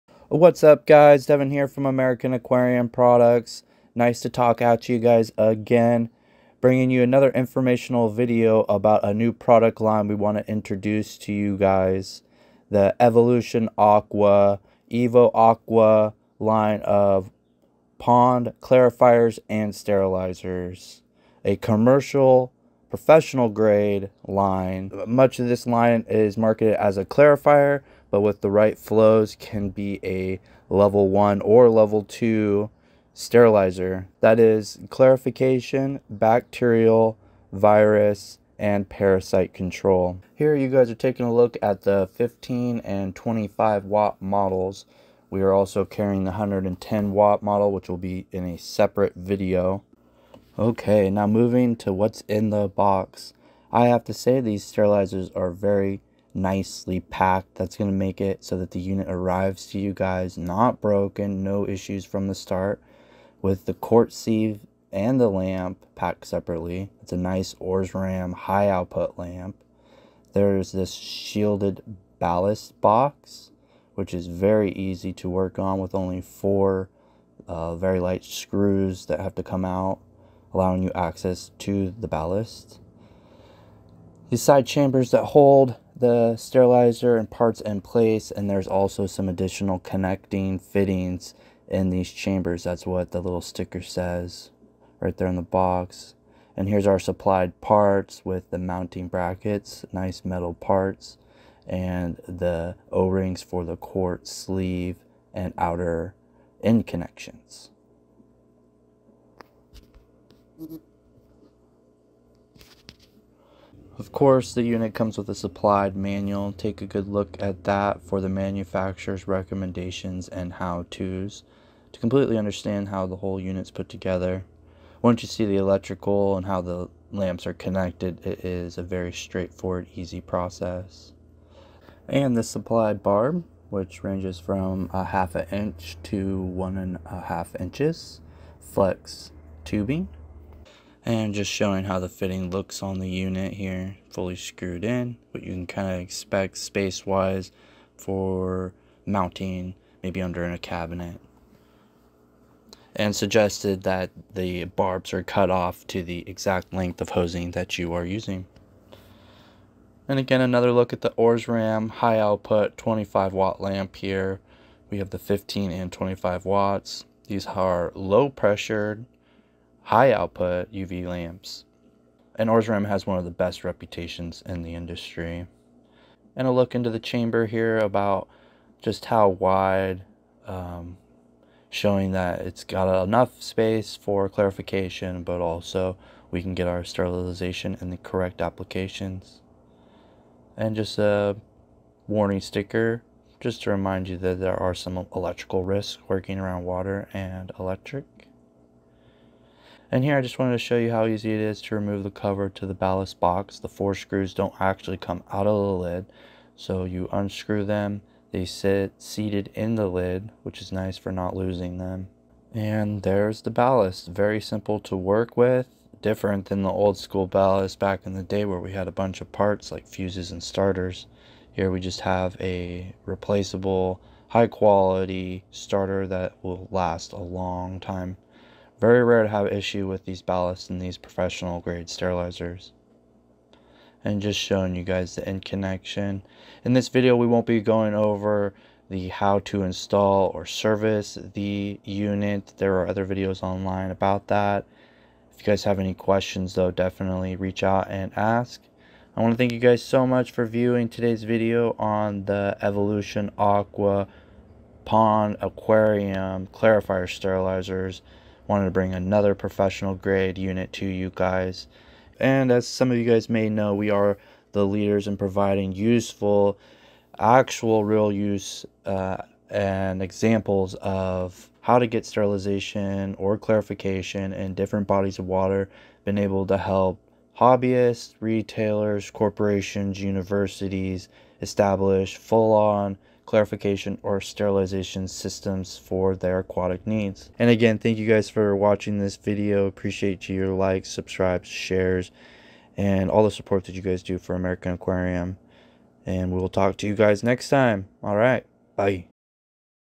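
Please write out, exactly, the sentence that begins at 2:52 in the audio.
And Osram has one of the best reputations in the industry.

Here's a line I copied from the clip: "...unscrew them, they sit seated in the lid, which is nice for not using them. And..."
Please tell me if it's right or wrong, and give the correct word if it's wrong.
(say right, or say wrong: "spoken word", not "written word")
wrong: "losing", not "using".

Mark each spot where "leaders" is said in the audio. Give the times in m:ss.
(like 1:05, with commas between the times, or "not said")
4:24.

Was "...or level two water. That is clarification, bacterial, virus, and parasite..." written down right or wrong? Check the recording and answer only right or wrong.
wrong.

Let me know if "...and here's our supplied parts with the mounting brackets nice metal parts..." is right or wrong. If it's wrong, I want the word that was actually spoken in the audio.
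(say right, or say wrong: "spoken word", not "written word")
right.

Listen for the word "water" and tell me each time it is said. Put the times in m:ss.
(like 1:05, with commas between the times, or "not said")
3:16, 4:35.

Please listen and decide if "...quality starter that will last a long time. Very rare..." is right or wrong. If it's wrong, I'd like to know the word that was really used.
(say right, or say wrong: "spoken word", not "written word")
right.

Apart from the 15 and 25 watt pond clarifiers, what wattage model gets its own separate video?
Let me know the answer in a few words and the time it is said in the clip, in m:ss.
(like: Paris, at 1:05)
110 watt, at 0:46.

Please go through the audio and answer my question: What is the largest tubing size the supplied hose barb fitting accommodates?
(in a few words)
1.5 inches.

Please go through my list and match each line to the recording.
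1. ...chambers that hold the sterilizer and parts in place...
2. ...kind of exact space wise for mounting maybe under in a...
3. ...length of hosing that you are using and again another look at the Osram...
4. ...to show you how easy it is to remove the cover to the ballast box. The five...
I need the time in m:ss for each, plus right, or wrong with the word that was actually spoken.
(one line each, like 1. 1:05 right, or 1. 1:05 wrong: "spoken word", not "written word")
1. 1:24 right
2. 2:25 wrong: "expect", not "exact"
3. 2:36 right
4. 3:20 wrong: "four", not "five".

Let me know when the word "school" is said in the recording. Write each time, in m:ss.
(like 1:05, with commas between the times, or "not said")
3:36.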